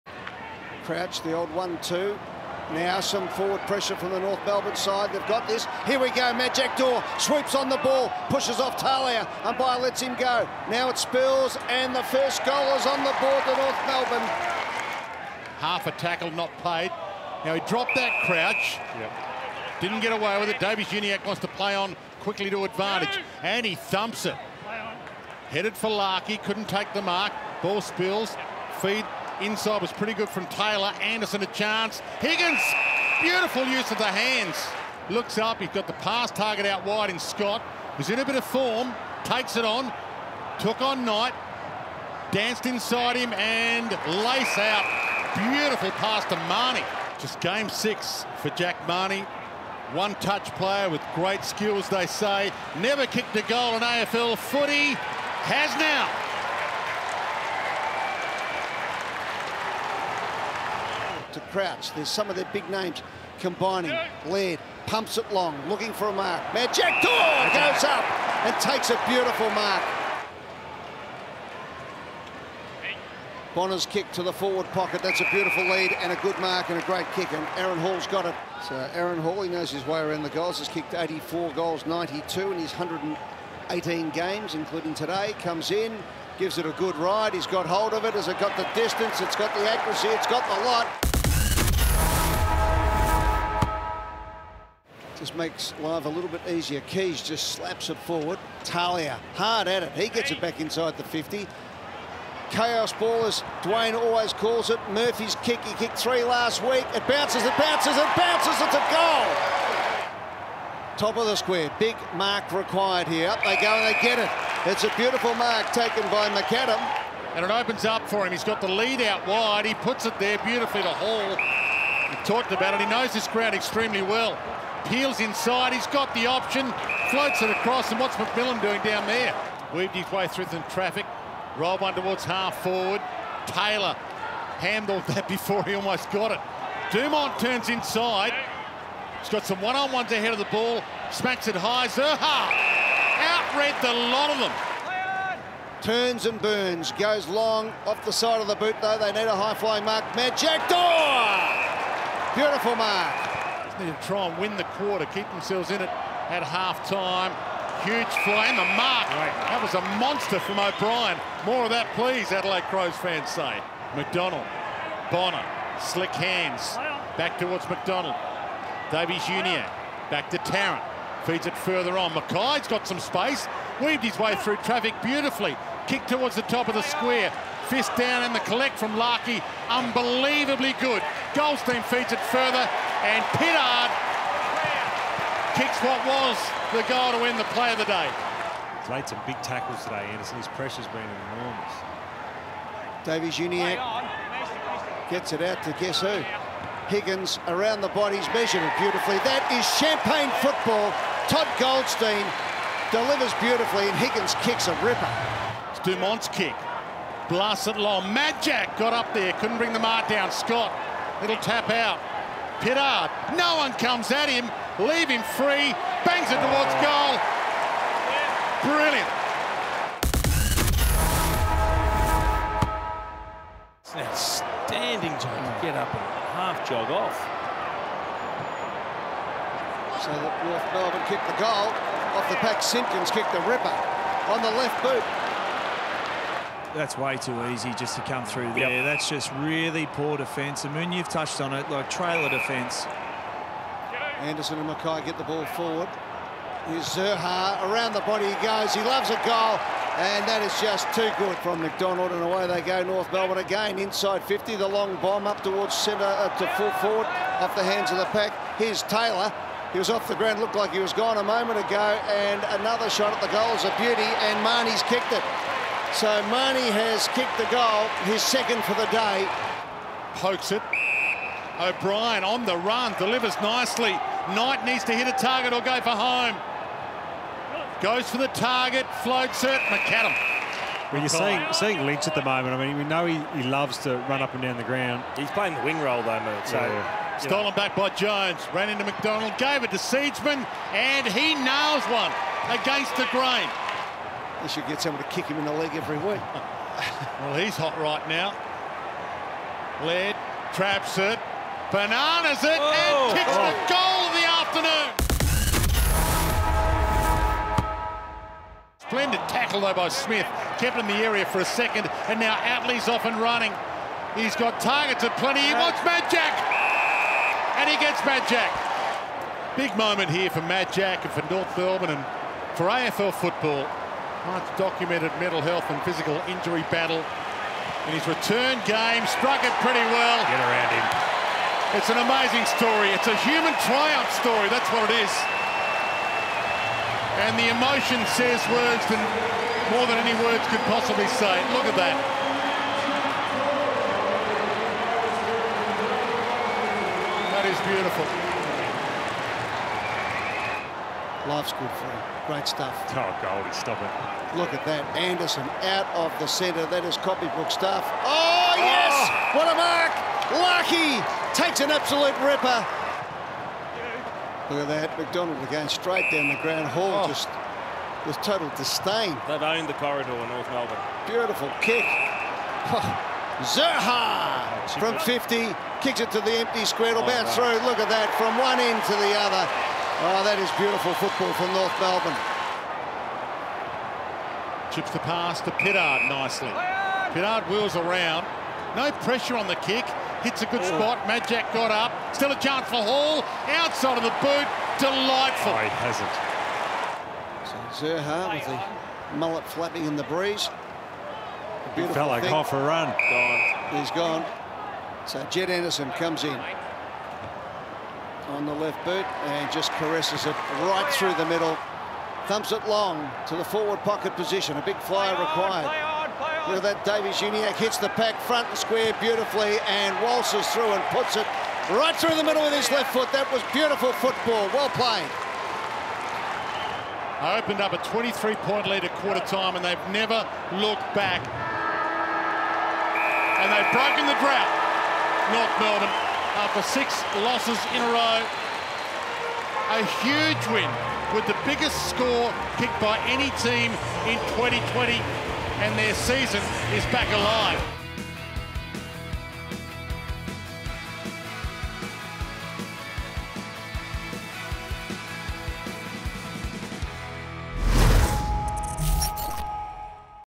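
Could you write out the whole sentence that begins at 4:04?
Anderson and Mackay get the ball forward.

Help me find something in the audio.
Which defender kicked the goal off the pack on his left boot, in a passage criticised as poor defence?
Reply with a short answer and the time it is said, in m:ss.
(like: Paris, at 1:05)
Simpkins, at 3:52.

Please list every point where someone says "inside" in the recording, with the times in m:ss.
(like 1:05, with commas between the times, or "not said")
0:29, 0:42, 1:40, 2:05, 2:17, 4:13.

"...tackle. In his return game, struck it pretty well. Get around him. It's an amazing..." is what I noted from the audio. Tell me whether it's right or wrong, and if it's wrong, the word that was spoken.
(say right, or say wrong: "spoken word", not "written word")
wrong: "battle", not "tackle".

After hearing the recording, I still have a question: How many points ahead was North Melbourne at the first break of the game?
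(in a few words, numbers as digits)
23.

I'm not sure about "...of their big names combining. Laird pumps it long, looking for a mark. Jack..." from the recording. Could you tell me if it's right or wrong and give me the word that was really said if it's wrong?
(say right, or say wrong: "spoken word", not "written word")
right.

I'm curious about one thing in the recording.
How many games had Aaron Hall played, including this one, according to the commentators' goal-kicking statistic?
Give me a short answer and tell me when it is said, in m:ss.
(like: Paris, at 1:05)
118, at 1:22.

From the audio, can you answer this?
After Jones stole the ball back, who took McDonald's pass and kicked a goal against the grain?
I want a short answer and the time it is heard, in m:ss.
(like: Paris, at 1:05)
Seedsman, at 4:49.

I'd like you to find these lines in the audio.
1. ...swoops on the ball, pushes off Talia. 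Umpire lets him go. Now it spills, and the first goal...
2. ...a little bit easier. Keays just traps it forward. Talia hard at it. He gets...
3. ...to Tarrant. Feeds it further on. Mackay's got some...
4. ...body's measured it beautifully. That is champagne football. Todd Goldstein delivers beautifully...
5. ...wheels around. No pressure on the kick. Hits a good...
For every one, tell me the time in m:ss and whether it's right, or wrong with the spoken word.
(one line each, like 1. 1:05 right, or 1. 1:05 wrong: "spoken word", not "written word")
1. 0:07 right
2. 1:36 wrong: "slaps", not "traps"
3. 2:50 right
4. 3:17 right
5. 6:27 right.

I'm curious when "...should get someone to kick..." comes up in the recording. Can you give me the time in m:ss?
4:54.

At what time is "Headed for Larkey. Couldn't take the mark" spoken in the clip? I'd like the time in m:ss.
0:25.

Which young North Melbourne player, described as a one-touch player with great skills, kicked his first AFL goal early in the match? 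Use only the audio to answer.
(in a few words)
Jack Mahony.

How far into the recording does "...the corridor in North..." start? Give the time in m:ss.
6:09.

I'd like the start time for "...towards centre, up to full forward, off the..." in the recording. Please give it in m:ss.
4:15.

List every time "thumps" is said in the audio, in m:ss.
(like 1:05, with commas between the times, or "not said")
0:23, 6:52.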